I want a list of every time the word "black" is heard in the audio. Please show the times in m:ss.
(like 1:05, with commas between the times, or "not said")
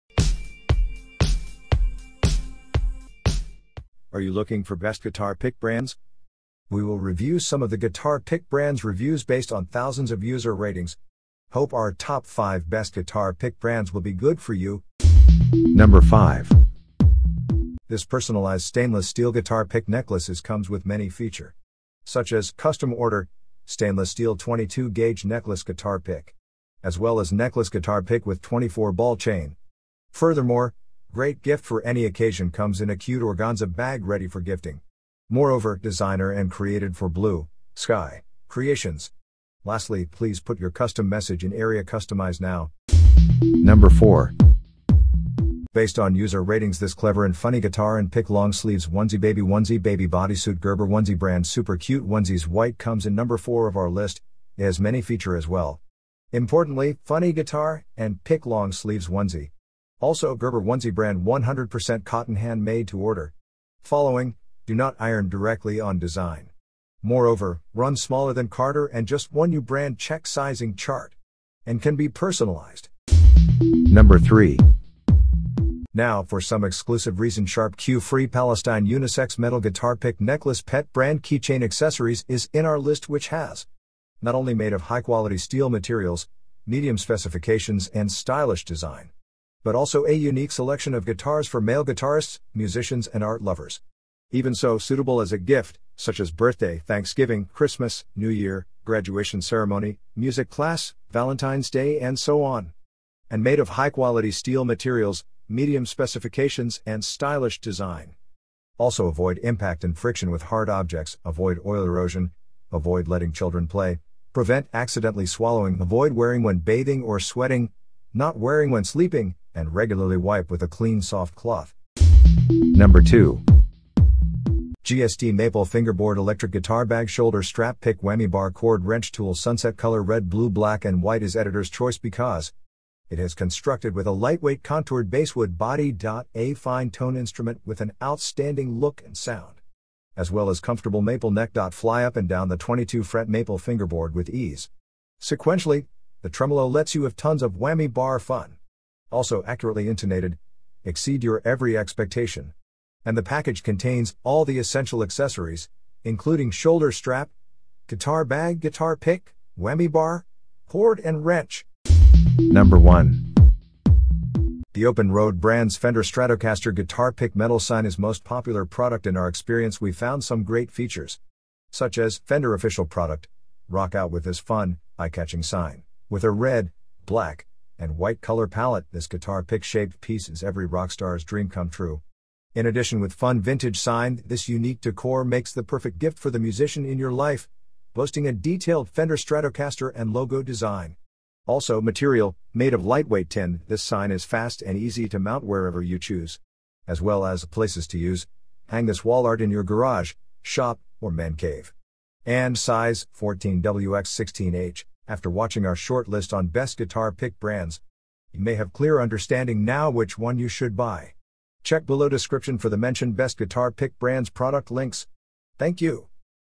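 2:10, 2:57.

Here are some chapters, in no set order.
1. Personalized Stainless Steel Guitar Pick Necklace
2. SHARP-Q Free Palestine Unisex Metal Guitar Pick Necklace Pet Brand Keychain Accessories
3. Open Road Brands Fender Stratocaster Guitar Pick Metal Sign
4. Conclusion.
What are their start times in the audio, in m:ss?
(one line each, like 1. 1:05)
1. 0:15
2. 1:11
3. 2:38
4. 3:20.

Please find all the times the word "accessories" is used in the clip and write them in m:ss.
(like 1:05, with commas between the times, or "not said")
1:21, 2:35.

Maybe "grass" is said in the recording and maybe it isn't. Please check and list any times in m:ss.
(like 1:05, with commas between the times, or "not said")
not said.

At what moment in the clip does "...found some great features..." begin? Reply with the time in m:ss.
2:49.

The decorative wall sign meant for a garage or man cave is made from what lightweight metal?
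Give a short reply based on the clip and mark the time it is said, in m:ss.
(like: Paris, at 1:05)
tin, at 3:13.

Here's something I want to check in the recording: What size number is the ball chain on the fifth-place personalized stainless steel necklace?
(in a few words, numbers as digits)
24.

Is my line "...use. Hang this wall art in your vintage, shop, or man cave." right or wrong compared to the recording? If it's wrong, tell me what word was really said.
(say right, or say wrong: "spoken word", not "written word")
wrong: "garage", not "vintage".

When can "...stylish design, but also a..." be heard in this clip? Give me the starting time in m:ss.
1:28.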